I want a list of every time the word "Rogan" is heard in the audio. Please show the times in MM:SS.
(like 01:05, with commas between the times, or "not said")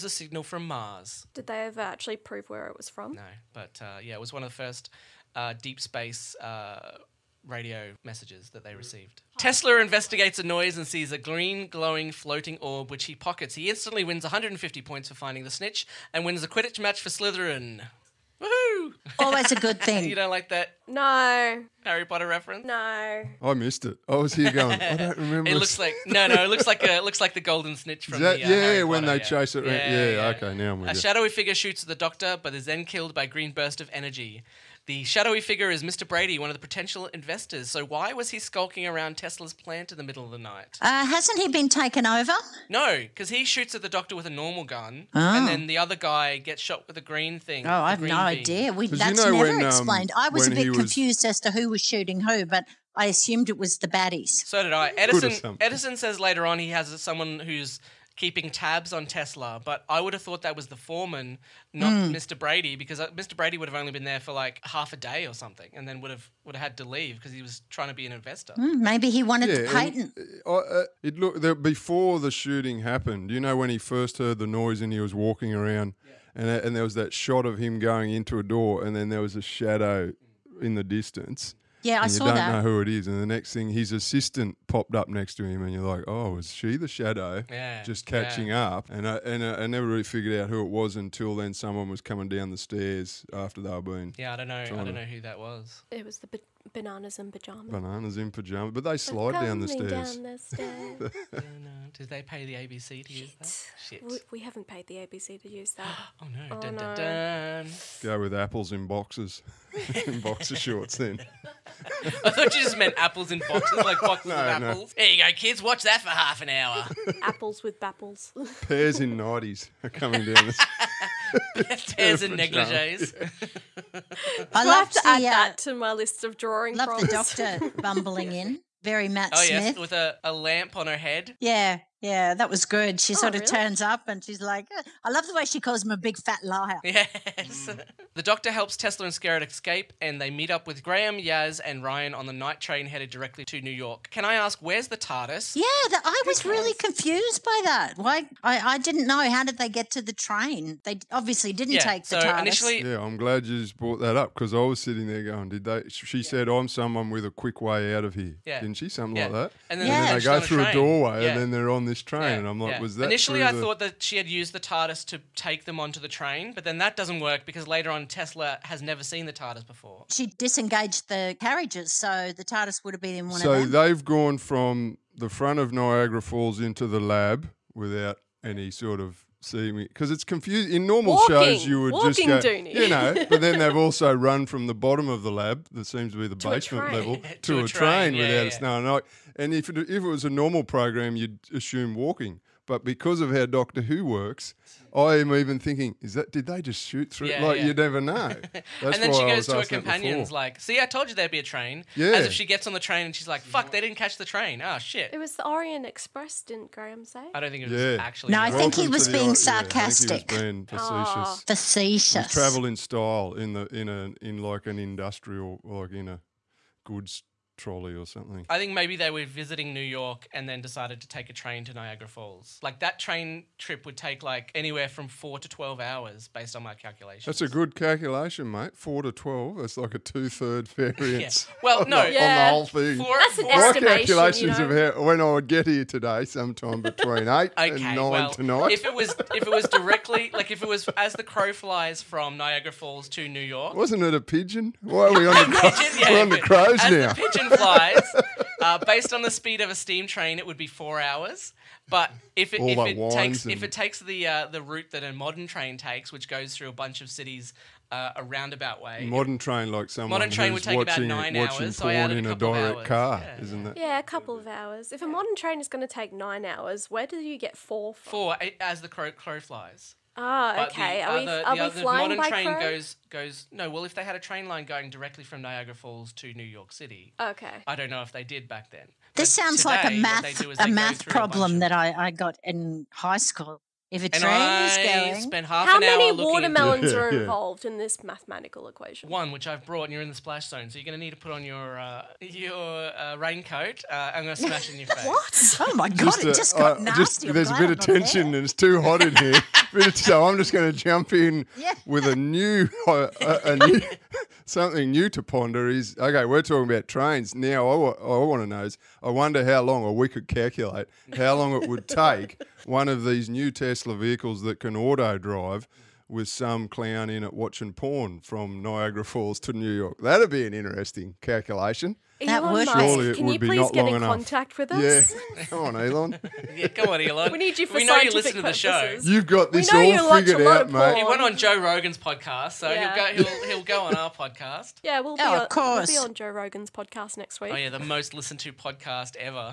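05:31, 05:36.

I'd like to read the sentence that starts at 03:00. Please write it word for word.
In normal walking, shows, you would just go, Doony.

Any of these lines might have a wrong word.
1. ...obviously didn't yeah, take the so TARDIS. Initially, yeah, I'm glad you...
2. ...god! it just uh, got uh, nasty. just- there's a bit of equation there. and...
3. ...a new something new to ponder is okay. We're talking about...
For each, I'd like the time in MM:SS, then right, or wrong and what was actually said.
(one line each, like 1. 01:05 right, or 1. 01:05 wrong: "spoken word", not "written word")
1. 02:31 right
2. 04:55 wrong: "tension", not "equation"
3. 05:03 right.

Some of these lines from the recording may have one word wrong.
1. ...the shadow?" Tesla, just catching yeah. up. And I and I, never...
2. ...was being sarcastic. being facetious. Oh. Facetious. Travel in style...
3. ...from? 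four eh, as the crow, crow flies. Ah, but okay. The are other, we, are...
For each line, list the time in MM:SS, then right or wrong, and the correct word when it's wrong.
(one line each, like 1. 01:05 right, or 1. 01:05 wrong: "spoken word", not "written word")
1. 01:26 wrong: "Yeah", not "Tesla"
2. 03:28 right
3. 04:27 right.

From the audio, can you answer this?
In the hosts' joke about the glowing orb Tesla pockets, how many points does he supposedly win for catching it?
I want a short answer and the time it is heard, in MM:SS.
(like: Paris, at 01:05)
150, at 00:14.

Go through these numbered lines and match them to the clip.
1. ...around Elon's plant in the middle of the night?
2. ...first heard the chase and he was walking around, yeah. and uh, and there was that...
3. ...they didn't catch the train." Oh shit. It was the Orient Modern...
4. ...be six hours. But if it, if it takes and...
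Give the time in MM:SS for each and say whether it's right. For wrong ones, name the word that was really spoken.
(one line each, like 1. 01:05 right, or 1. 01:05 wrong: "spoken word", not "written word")
1. 00:38 wrong: "Tesla", not "Elon"
2. 01:13 wrong: "noise", not "chase"
3. 03:23 wrong: "Express", not "Modern"
4. 04:10 wrong: "four", not "six".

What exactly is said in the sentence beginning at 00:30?
shadowy figure shoots at the doctor, but is then killed by a green burst of energy.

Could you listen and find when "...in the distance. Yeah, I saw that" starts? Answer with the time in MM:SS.
01:20.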